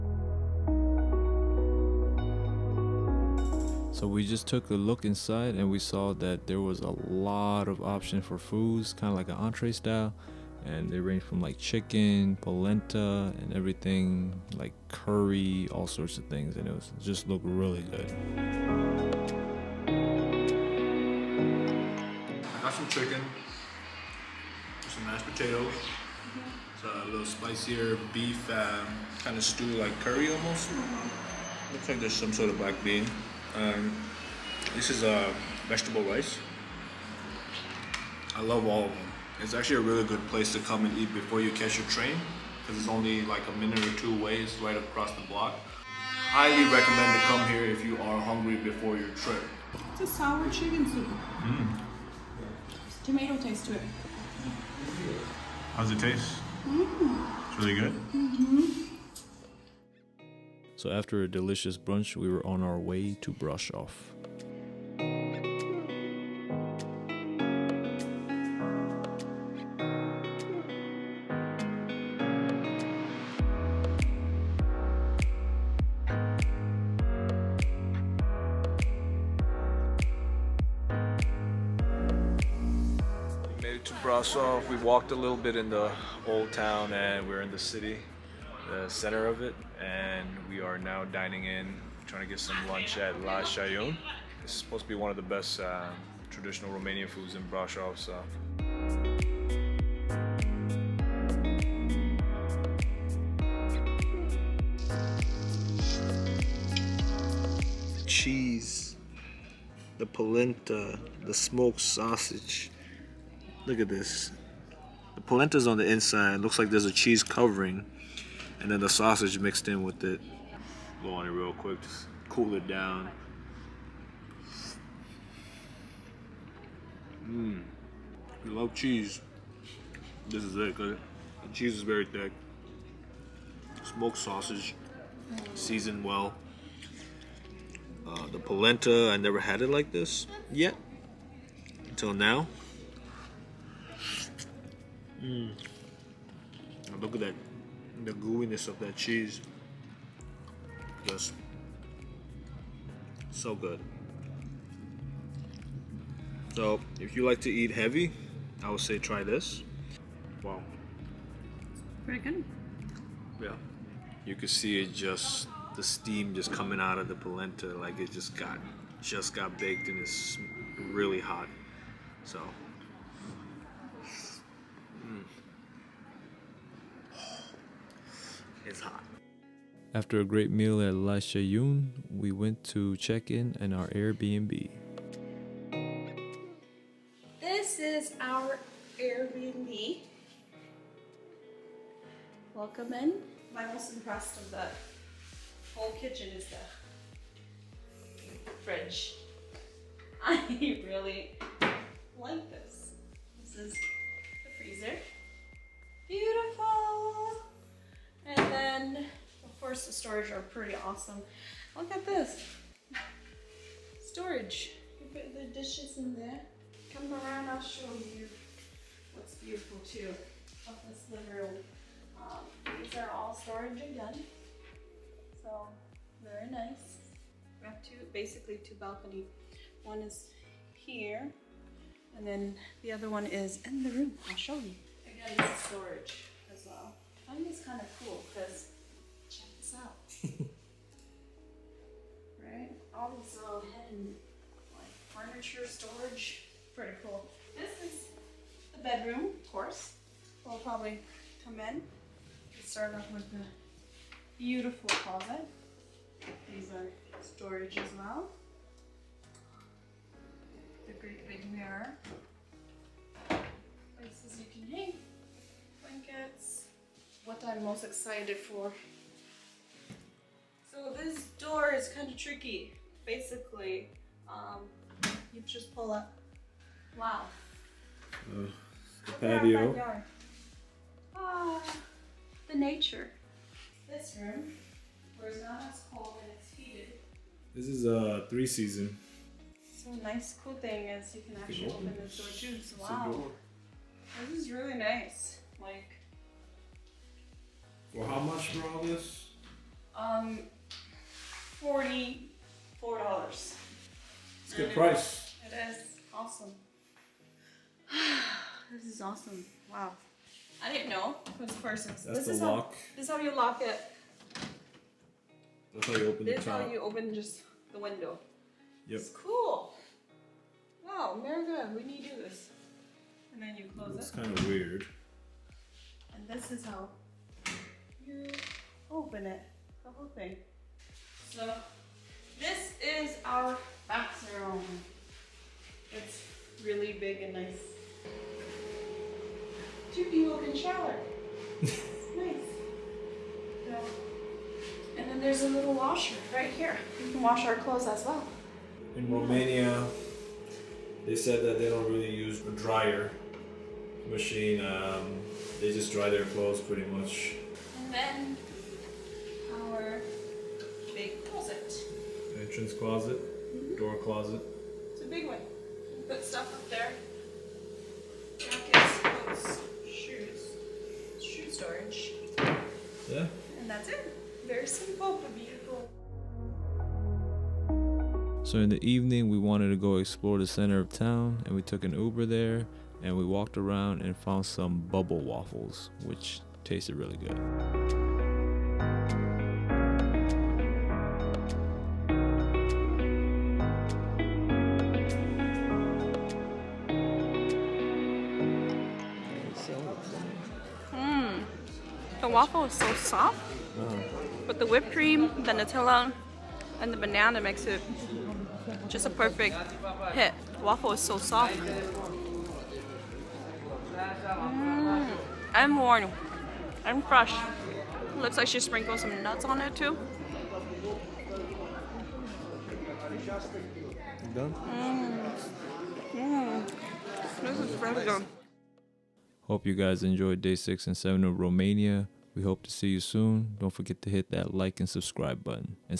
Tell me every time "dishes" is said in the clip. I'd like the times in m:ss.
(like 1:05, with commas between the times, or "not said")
3:35.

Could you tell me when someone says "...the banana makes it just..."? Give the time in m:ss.
6:46.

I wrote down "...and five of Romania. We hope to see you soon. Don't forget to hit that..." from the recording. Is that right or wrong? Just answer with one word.
wrong.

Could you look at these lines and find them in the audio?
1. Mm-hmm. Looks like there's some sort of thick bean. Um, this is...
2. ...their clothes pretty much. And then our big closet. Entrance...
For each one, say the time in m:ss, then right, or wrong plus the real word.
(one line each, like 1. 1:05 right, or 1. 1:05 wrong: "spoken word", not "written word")
1. 0:30 wrong: "black", not "thick"
2. 5:56 right.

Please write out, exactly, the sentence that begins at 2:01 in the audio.
Blow on it real quick, just cool it down.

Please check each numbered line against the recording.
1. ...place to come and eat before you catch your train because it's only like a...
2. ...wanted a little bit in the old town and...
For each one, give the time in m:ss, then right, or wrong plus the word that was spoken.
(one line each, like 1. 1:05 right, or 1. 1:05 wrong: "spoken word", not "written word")
1. 0:40 right
2. 1:24 wrong: "walked", not "wanted".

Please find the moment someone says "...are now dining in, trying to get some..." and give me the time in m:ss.
1:30.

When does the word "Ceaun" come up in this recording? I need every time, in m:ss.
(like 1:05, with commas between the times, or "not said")
1:33, 3:01.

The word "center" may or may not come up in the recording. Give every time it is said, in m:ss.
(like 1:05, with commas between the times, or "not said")
1:28, 6:20.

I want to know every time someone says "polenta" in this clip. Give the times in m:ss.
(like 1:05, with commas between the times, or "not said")
0:12, 1:50, 2:18, 2:47.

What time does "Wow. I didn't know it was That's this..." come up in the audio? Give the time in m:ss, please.
5:09.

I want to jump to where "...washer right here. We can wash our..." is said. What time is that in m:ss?
5:45.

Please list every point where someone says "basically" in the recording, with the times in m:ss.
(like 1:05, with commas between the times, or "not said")
3:48, 4:33.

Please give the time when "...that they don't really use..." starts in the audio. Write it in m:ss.
5:51.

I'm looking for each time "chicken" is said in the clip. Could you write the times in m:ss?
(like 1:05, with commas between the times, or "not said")
0:11, 0:23, 0:50.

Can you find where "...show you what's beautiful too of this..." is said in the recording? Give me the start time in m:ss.
3:37.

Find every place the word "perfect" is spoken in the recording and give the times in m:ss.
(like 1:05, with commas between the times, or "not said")
6:49.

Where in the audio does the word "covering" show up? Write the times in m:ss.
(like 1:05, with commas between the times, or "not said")
1:57.